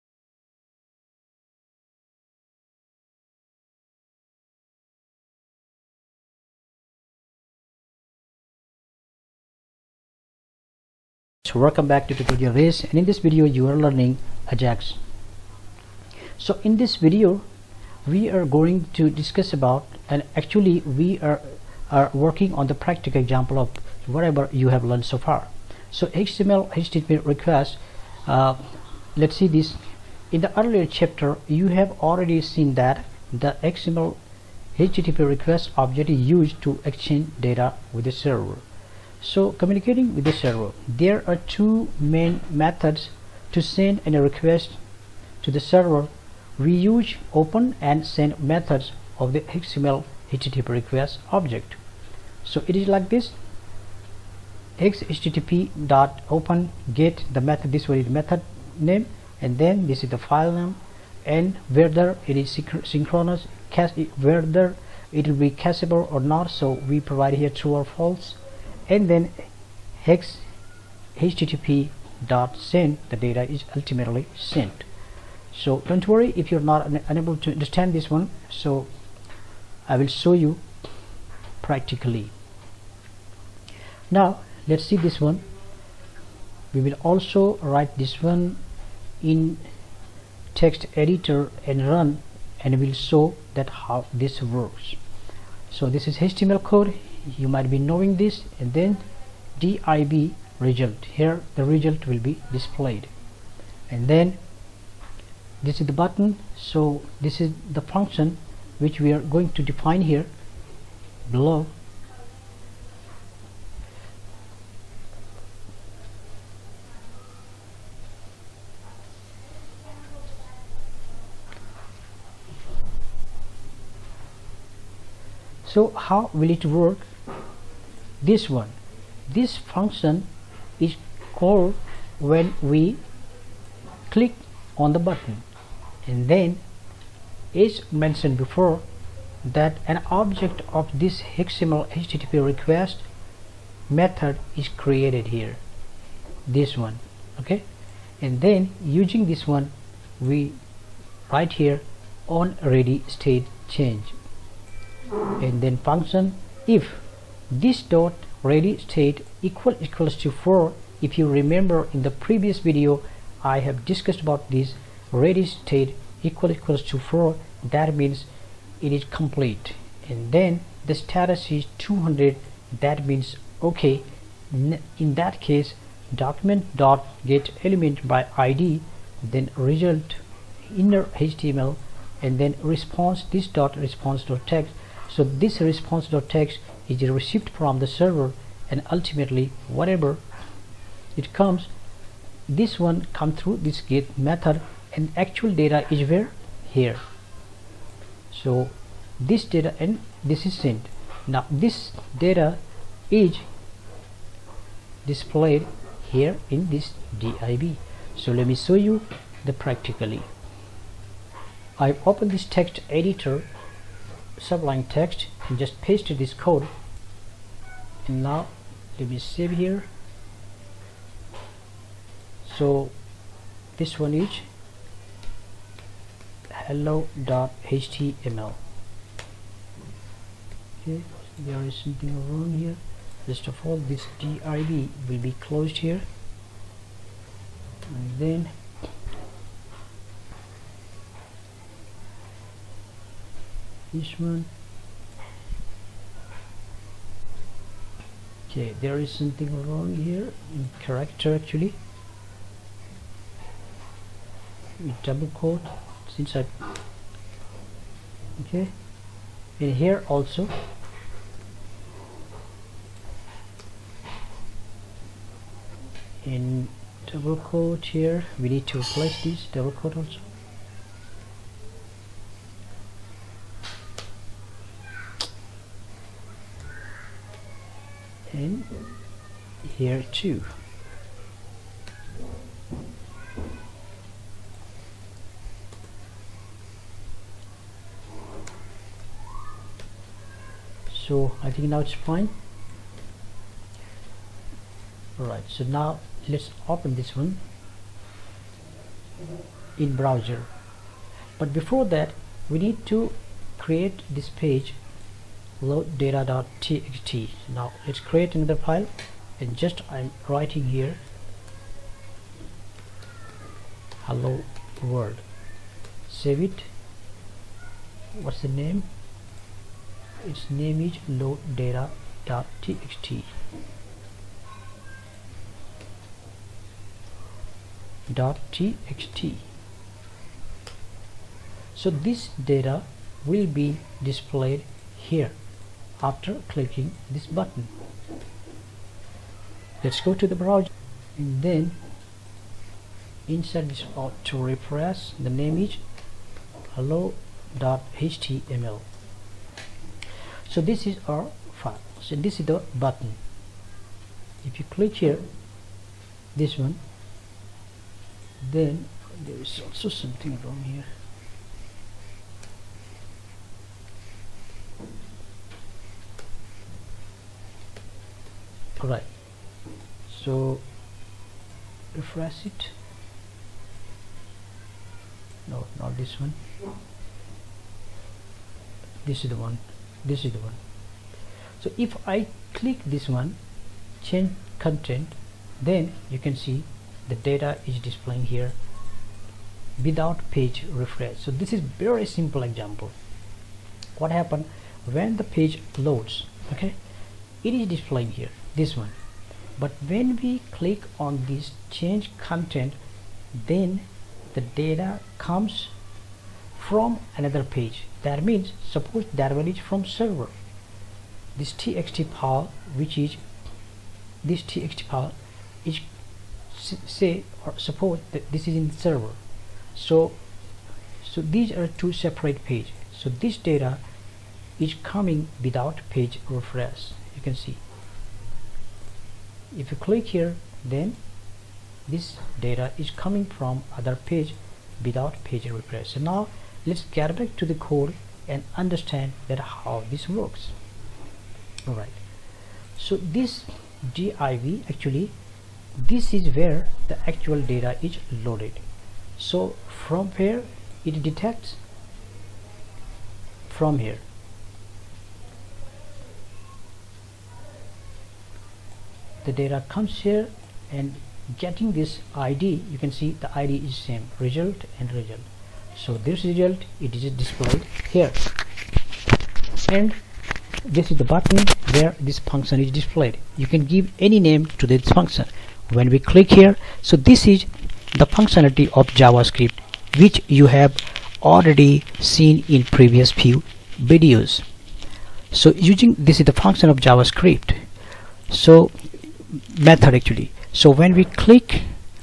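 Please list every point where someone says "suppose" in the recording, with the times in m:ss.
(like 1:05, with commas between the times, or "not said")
6:48, 6:57.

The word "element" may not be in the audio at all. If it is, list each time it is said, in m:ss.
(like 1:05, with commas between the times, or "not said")
2:57.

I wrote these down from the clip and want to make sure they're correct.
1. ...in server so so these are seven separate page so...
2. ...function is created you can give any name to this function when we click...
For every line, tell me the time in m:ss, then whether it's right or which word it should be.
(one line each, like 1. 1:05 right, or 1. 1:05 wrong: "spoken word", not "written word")
1. 6:58 wrong: "two", not "seven"
2. 7:52 wrong: "displayed", not "created".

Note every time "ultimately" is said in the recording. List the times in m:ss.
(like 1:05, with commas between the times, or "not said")
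1:13, 3:08.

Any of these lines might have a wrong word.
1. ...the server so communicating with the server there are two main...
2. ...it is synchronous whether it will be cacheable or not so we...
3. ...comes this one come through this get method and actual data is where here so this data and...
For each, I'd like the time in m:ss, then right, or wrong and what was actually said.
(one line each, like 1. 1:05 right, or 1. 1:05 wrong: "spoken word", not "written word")
1. 0:38 right
2. 1:02 right
3. 3:11 right.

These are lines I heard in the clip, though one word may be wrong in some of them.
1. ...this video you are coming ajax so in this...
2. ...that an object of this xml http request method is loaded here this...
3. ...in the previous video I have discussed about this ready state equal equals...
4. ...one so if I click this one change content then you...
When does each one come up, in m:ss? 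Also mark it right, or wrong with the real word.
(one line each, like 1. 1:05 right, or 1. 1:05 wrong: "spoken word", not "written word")
1. 0:13 wrong: "learning", not "coming"
2. 2:19 wrong: "created", not "loaded"
3. 2:41 right
4. 6:20 right.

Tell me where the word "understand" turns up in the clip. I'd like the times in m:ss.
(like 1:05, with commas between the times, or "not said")
1:17, 7:18.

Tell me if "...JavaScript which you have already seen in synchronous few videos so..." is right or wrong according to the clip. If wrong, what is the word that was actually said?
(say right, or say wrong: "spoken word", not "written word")
wrong: "previous", not "synchronous".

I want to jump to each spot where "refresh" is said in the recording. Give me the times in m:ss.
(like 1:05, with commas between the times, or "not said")
6:11, 6:30, 7:06, 7:15.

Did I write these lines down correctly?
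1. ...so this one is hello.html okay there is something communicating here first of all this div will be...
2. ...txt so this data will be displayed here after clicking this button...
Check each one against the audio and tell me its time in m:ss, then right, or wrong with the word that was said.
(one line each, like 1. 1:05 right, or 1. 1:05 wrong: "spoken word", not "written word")
1. 3:42 wrong: "wrong", not "communicating"
2. 5:28 right.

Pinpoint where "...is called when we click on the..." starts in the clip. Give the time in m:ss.
2:10.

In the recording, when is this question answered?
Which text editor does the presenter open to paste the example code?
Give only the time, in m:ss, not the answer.
3:34.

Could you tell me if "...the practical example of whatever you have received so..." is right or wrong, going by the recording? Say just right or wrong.
wrong.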